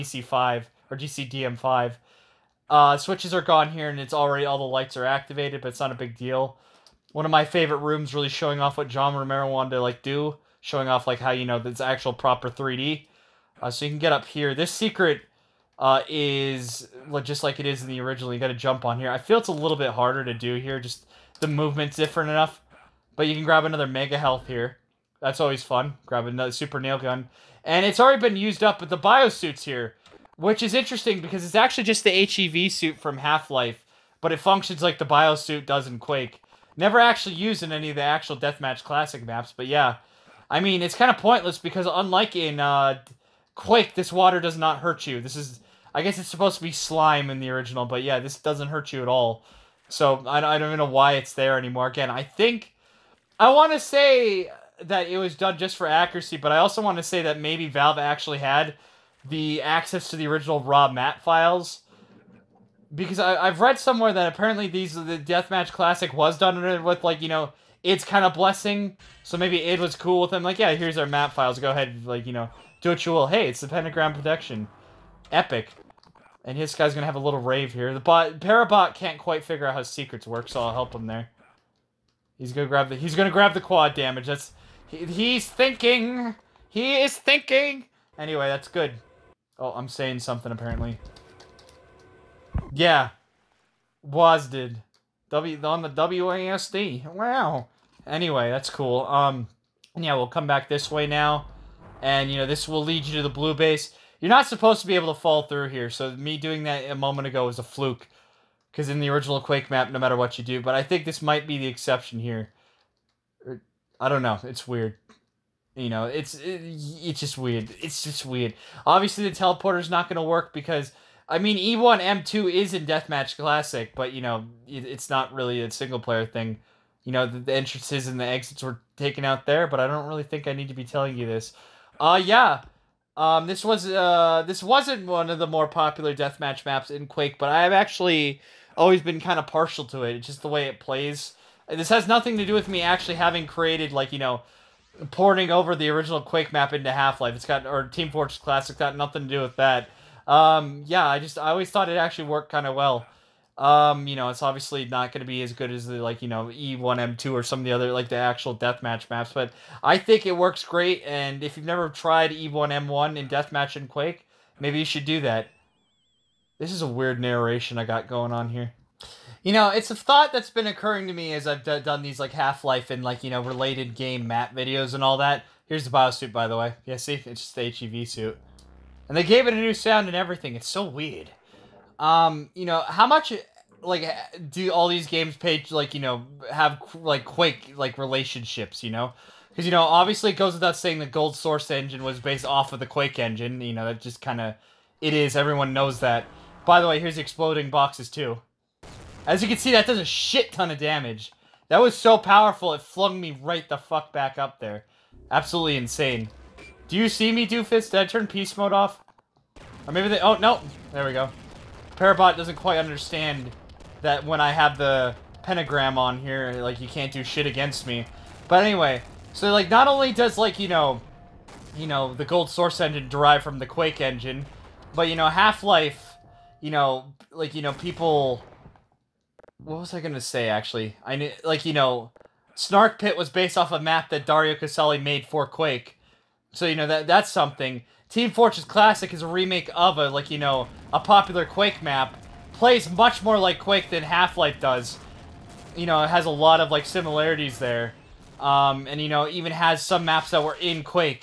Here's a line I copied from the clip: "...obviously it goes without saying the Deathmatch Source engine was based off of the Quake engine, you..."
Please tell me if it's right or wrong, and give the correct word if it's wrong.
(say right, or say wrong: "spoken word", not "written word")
wrong: "Gold", not "Deathmatch".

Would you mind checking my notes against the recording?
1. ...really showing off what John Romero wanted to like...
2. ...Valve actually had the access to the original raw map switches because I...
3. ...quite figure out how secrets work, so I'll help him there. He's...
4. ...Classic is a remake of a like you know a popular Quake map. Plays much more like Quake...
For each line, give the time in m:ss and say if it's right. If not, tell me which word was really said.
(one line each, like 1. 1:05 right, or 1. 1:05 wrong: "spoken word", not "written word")
1. 0:08 right
2. 0:57 wrong: "files", not "switches"
3. 1:19 right
4. 3:58 right.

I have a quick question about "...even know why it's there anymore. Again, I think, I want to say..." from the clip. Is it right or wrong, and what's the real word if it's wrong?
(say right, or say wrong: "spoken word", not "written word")
right.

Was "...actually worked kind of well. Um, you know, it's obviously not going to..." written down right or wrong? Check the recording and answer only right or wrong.
right.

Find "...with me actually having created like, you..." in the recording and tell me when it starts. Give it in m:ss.
2:22.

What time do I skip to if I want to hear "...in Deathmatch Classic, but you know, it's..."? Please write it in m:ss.
2:02.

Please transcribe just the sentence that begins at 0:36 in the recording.
Never actually used in any of the actual Deathmatch Classic maps, but yeah.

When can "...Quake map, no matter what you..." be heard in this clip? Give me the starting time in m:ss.
1:49.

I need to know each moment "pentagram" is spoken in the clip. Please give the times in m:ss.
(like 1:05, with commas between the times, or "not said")
1:13, 3:35.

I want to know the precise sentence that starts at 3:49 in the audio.
What was I gonna say, actually?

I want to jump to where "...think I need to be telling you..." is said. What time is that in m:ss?
2:10.